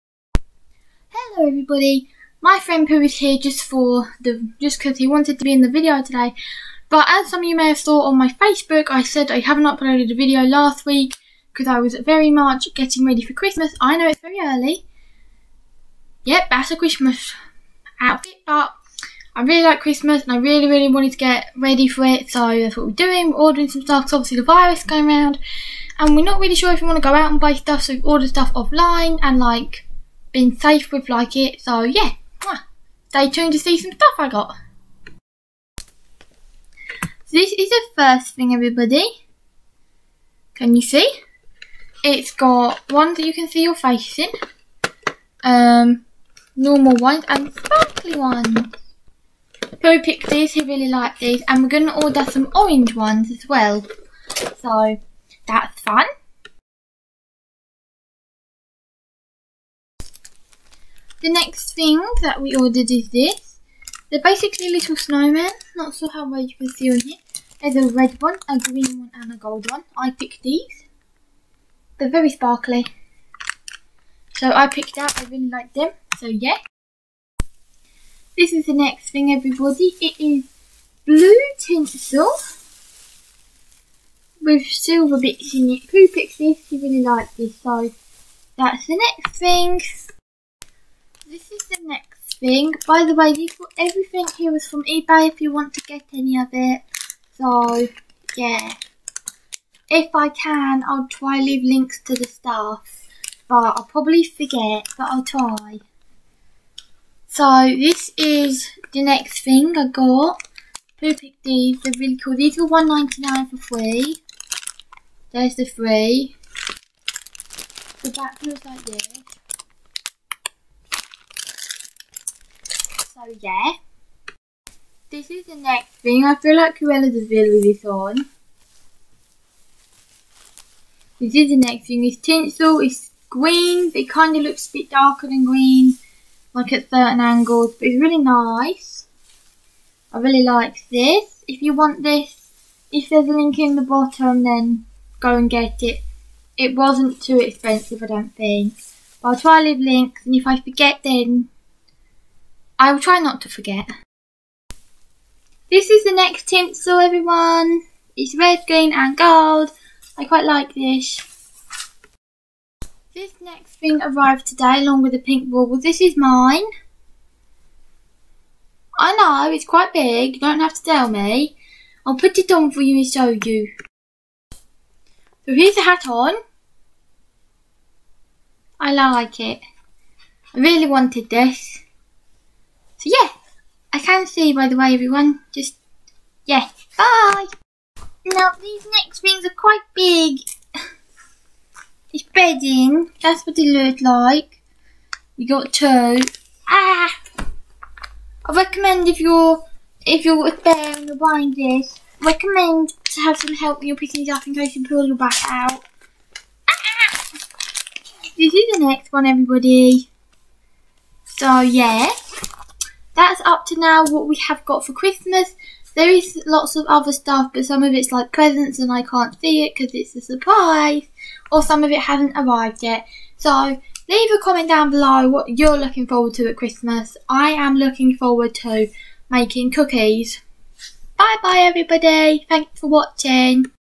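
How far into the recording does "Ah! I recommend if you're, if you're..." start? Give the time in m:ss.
3:16.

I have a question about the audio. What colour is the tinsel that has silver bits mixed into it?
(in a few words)
Blue.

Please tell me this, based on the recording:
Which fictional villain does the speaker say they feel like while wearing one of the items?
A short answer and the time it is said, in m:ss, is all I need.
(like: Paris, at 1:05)
Cruella de Vil, at 2:06.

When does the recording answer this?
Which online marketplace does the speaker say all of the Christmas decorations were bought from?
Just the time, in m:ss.
1:34.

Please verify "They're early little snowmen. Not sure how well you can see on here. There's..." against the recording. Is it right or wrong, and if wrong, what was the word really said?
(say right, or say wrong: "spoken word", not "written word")
wrong: "basically", not "early".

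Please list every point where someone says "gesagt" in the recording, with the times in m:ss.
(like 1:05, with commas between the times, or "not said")
not said.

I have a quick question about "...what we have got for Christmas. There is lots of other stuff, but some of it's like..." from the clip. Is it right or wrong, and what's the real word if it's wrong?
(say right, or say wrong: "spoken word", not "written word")
right.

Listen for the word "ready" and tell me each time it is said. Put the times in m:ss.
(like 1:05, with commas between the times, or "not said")
0:13, 0:21.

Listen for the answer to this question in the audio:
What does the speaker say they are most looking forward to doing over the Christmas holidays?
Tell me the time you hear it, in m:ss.
3:49.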